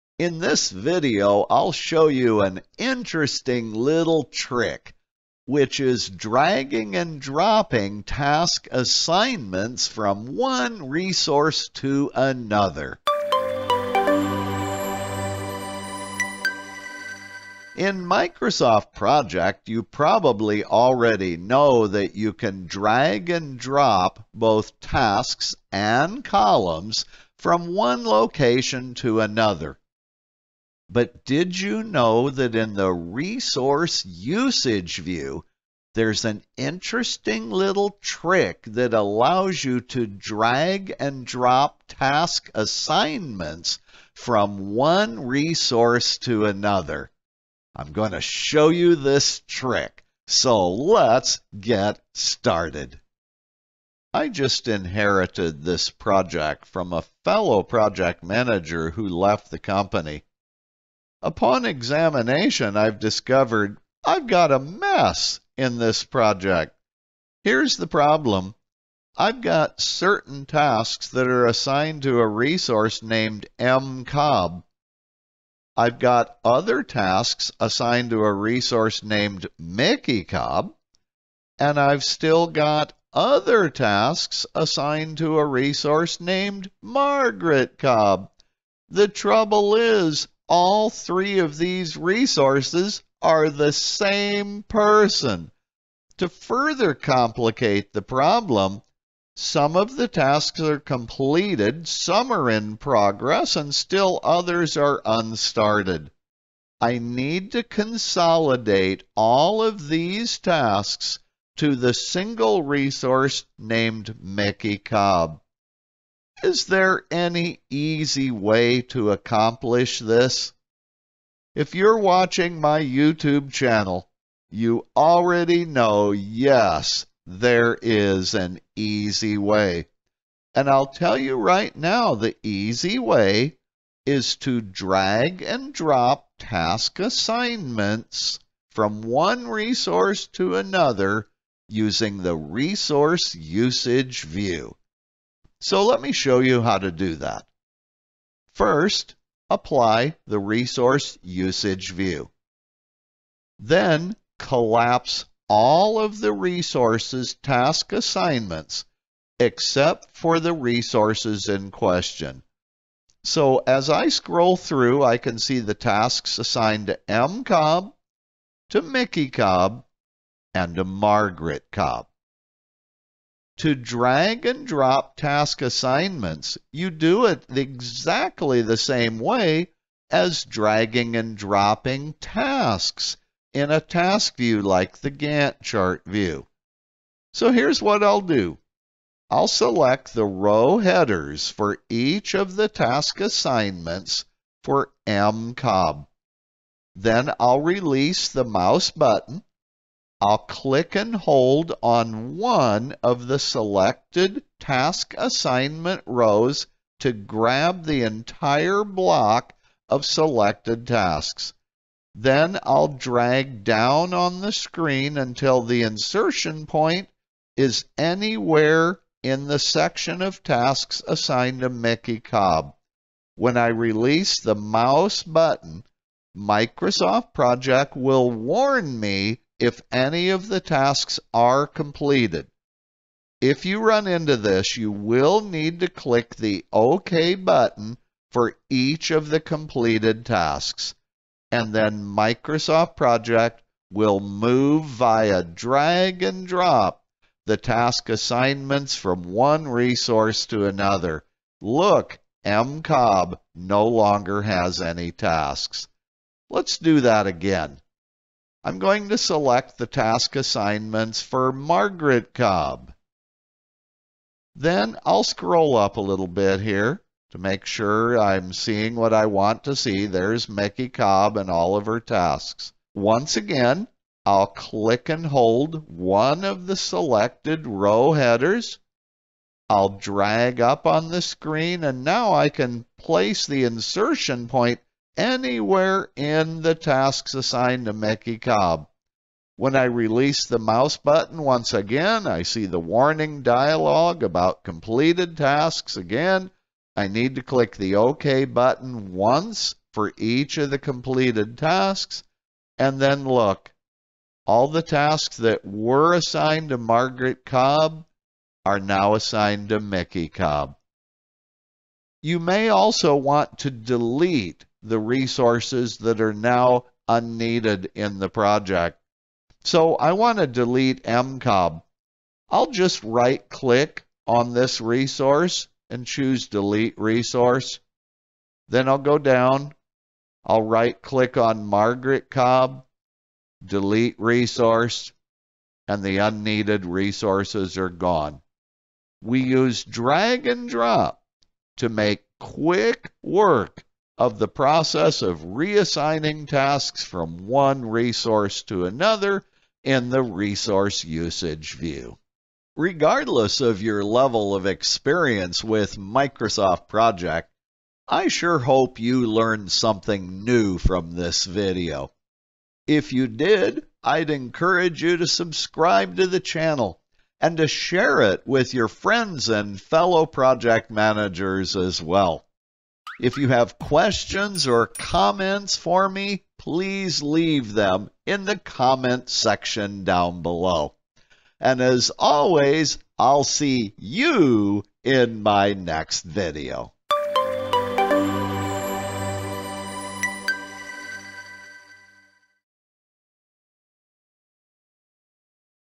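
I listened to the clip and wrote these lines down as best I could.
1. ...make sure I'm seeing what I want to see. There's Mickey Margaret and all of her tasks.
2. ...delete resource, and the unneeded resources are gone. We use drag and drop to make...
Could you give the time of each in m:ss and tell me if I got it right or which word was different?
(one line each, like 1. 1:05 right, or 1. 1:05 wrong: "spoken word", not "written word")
1. 4:27 wrong: "Cobb", not "Margaret"
2. 5:33 right.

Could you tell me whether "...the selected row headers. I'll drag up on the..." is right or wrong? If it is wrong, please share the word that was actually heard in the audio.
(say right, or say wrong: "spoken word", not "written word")
right.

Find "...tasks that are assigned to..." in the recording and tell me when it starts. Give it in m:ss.
1:10.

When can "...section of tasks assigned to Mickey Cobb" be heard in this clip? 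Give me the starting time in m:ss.
3:39.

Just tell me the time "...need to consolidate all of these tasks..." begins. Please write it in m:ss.
1:46.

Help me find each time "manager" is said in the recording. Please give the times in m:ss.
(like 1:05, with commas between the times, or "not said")
0:58, 6:10.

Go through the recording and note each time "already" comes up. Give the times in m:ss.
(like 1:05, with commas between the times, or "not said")
0:20, 2:04.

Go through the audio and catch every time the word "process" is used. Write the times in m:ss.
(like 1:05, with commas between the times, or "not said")
5:44.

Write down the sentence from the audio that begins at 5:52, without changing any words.
Regardless of your level of experience with Microsoft Project, I sure hope you learned something new from this video.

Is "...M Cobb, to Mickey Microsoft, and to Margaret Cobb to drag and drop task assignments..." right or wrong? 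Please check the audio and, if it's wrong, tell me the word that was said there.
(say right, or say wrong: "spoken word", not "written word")
wrong: "Cobb", not "Microsoft".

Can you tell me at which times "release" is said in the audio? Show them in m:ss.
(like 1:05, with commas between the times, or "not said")
3:17, 3:43, 4:49.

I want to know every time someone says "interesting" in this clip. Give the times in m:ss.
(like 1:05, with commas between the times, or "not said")
0:02, 0:36.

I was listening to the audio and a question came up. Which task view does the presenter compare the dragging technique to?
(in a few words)
Gantt chart view.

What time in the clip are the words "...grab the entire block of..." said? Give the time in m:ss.
3:27.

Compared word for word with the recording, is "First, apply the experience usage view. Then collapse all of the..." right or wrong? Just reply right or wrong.
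wrong.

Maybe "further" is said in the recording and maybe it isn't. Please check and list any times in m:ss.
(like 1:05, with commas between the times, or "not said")
1:36.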